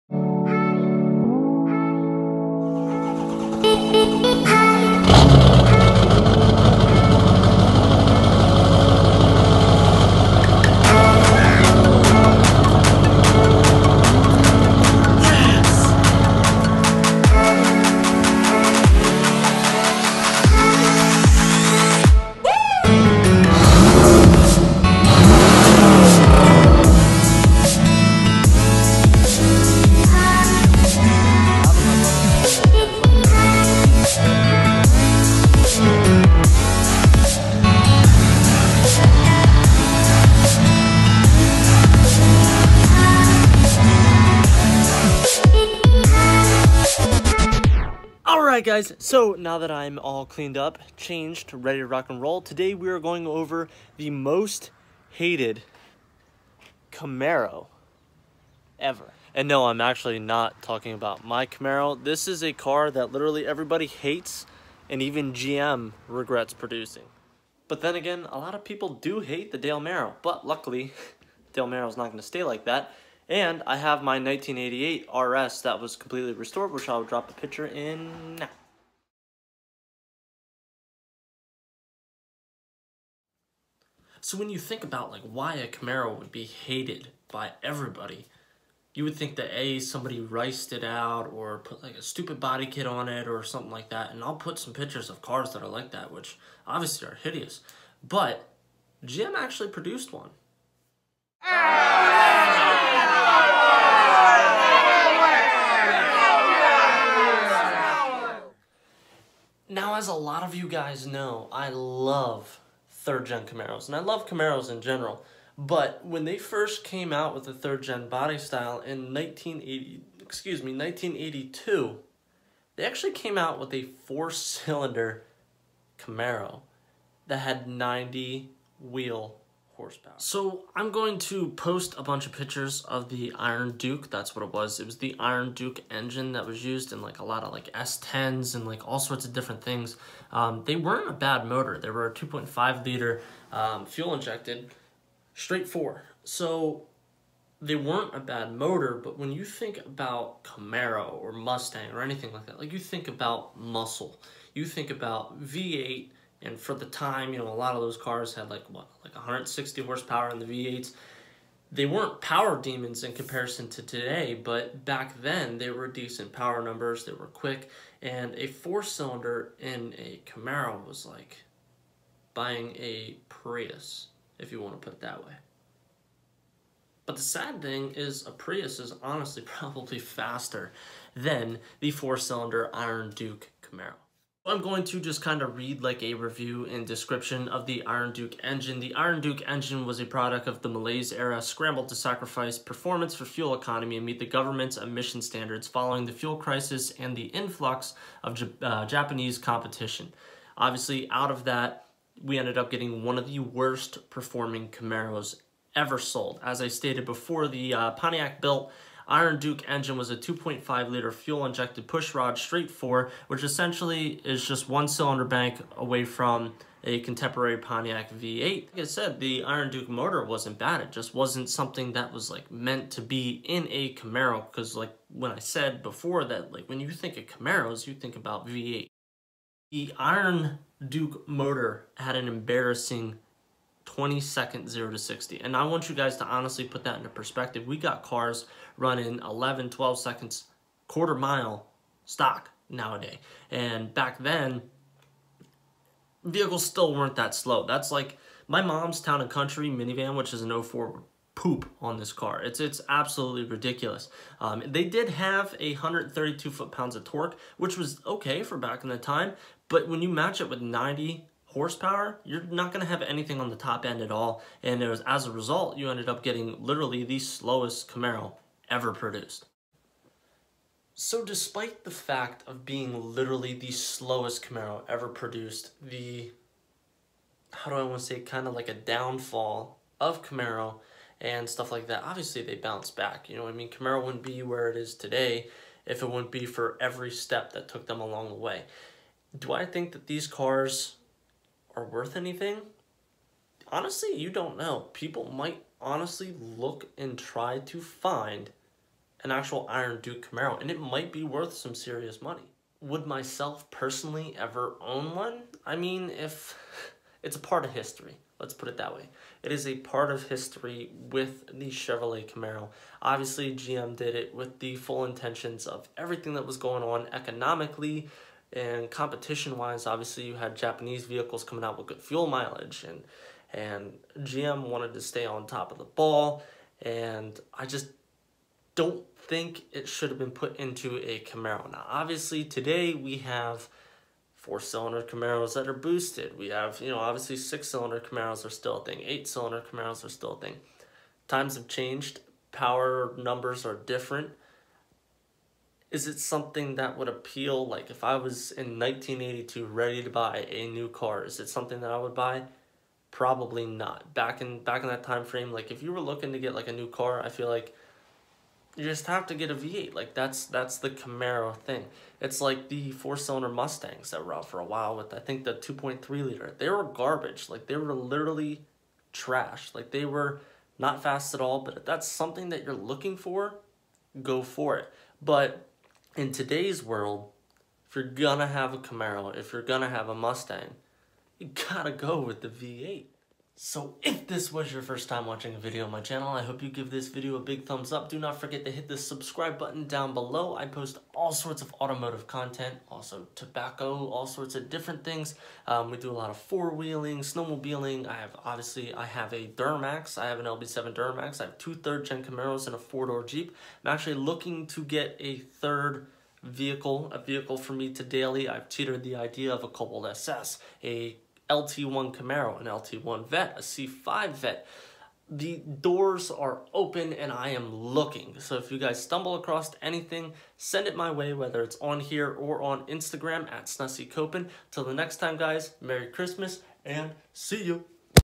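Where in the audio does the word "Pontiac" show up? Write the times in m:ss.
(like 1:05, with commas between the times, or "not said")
3:27, 3:37.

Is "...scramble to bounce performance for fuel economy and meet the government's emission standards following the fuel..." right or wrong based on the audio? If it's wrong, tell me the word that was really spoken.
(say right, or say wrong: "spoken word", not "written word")
wrong: "sacrifice", not "bounce".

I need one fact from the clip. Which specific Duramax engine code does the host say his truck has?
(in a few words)
LB7.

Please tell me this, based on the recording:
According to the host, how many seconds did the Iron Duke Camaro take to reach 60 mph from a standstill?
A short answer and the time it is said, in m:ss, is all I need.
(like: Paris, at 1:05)
22, at 3:53.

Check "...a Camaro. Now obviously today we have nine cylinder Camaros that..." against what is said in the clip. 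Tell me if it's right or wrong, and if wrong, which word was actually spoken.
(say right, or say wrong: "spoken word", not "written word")
wrong: "four", not "nine".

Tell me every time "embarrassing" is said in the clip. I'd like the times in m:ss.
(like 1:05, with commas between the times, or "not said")
3:52.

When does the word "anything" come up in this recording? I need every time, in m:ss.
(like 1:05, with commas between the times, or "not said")
2:32, 4:23, 4:52, 6:59.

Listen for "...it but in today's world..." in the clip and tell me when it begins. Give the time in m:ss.
6:14.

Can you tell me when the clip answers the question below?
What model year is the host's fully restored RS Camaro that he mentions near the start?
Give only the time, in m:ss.
1:14.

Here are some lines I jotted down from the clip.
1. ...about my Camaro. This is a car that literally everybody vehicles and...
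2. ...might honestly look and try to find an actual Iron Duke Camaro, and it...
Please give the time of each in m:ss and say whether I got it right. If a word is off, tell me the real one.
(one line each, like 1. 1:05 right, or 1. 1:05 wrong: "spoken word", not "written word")
1. 1:00 wrong: "hates", not "vehicles"
2. 4:55 right.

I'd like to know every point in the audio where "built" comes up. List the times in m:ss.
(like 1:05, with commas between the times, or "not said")
3:28.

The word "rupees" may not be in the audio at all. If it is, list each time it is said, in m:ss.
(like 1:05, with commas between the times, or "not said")
not said.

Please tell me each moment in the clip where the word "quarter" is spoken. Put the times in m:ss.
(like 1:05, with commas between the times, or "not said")
4:00.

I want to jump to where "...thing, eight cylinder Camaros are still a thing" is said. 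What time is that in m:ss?
5:38.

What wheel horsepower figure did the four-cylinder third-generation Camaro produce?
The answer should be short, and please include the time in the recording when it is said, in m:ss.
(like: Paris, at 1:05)
90, at 2:07.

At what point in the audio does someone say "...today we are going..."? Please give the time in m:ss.
0:52.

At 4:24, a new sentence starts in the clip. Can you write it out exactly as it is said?
And it was, as a result, you ended up getting literally the slowest Camaro ever produced.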